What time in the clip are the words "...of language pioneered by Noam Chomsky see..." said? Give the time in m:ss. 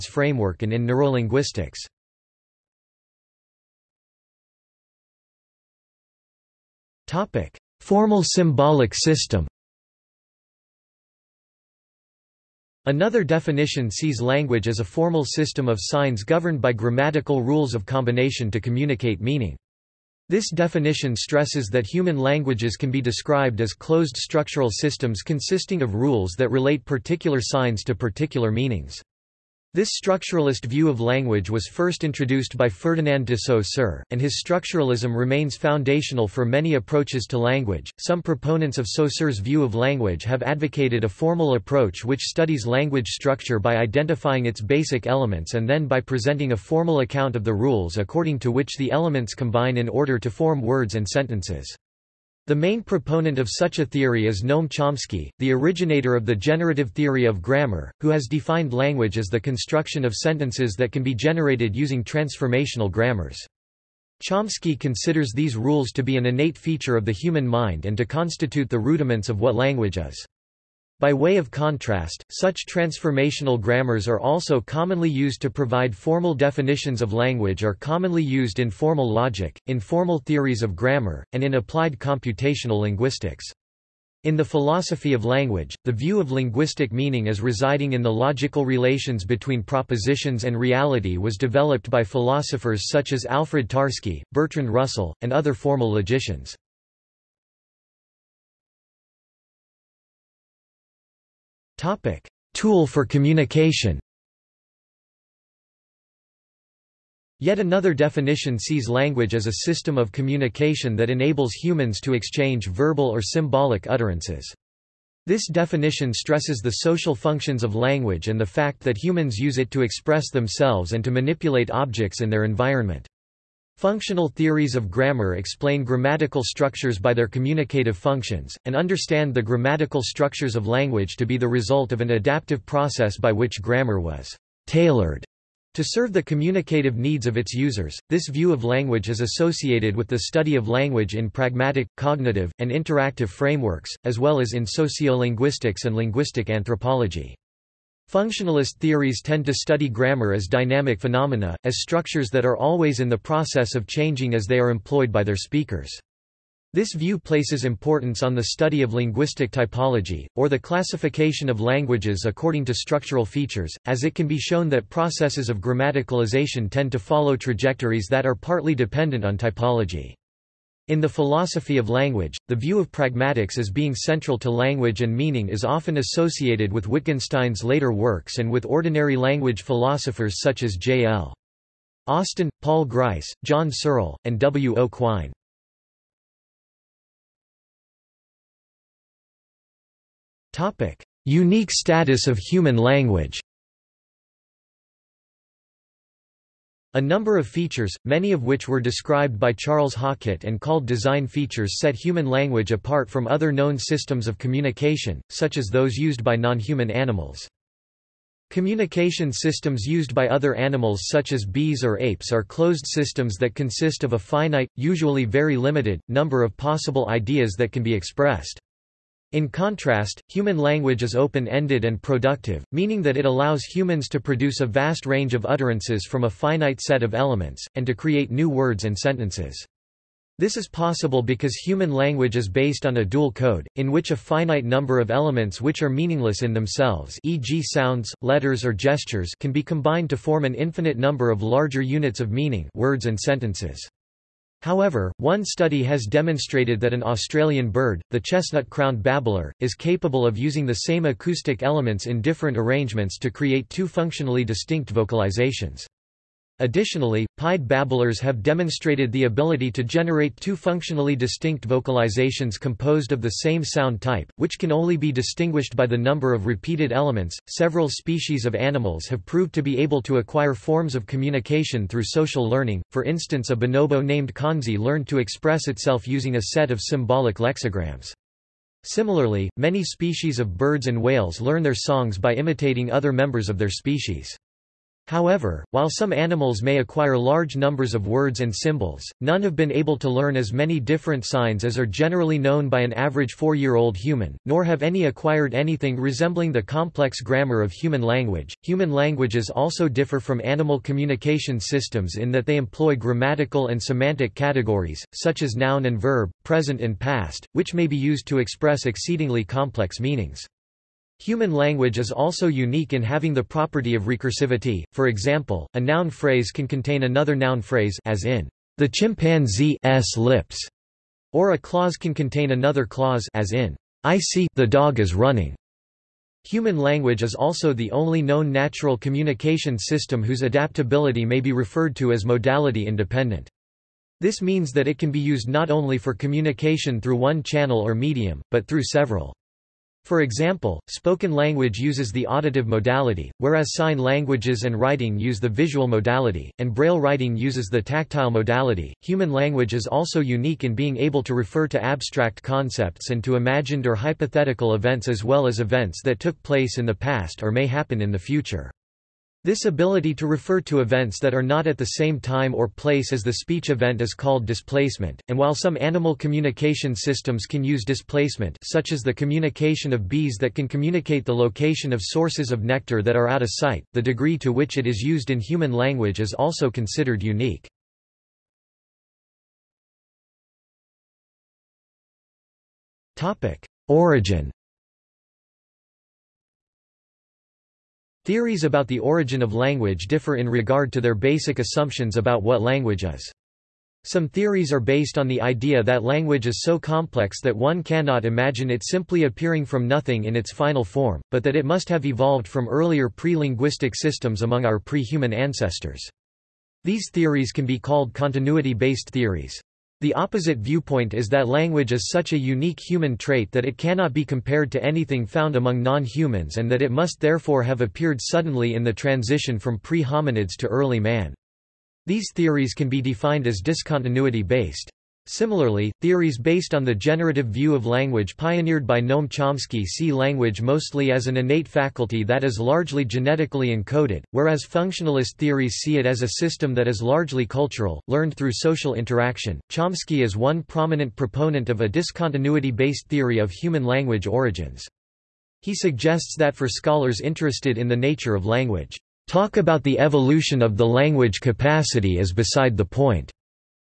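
7:07.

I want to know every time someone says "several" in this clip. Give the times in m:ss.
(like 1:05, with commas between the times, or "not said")
4:27, 5:38.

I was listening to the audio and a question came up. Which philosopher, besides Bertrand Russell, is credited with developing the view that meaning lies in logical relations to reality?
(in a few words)
Alfred Tarski.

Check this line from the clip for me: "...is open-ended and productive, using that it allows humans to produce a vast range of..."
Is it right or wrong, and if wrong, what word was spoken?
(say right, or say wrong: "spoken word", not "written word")
wrong: "meaning", not "using".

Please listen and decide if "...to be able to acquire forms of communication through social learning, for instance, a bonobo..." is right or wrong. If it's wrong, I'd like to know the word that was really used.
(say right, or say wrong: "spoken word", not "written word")
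right.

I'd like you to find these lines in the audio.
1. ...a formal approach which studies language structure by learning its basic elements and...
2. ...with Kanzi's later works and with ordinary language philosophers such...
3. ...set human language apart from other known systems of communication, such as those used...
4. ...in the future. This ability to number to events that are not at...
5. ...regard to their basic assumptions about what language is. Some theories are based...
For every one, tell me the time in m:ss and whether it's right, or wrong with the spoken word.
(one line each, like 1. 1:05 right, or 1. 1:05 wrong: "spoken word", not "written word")
1. 0:41 wrong: "identifying", not "learning"
2. 2:56 wrong: "Wittgenstein", not "Kanzi"
3. 3:21 right
4. 5:57 wrong: "refer", not "number"
5. 6:30 right.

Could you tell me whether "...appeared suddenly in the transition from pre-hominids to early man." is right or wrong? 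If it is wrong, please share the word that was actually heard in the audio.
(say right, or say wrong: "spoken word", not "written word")
right.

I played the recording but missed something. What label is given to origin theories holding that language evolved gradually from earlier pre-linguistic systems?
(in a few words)
continuity-based theories.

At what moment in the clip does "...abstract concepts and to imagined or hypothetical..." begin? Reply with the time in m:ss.
5:51.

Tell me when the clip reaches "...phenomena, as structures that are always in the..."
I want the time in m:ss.
2:30.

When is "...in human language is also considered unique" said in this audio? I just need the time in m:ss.
6:15.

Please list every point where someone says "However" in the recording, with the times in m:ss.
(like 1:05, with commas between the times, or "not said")
4:04, 4:45.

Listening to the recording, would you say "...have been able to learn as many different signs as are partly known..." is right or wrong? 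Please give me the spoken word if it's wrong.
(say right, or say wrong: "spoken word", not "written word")
wrong: "generally", not "partly".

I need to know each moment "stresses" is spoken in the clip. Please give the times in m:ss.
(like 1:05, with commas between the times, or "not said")
0:21, 1:56.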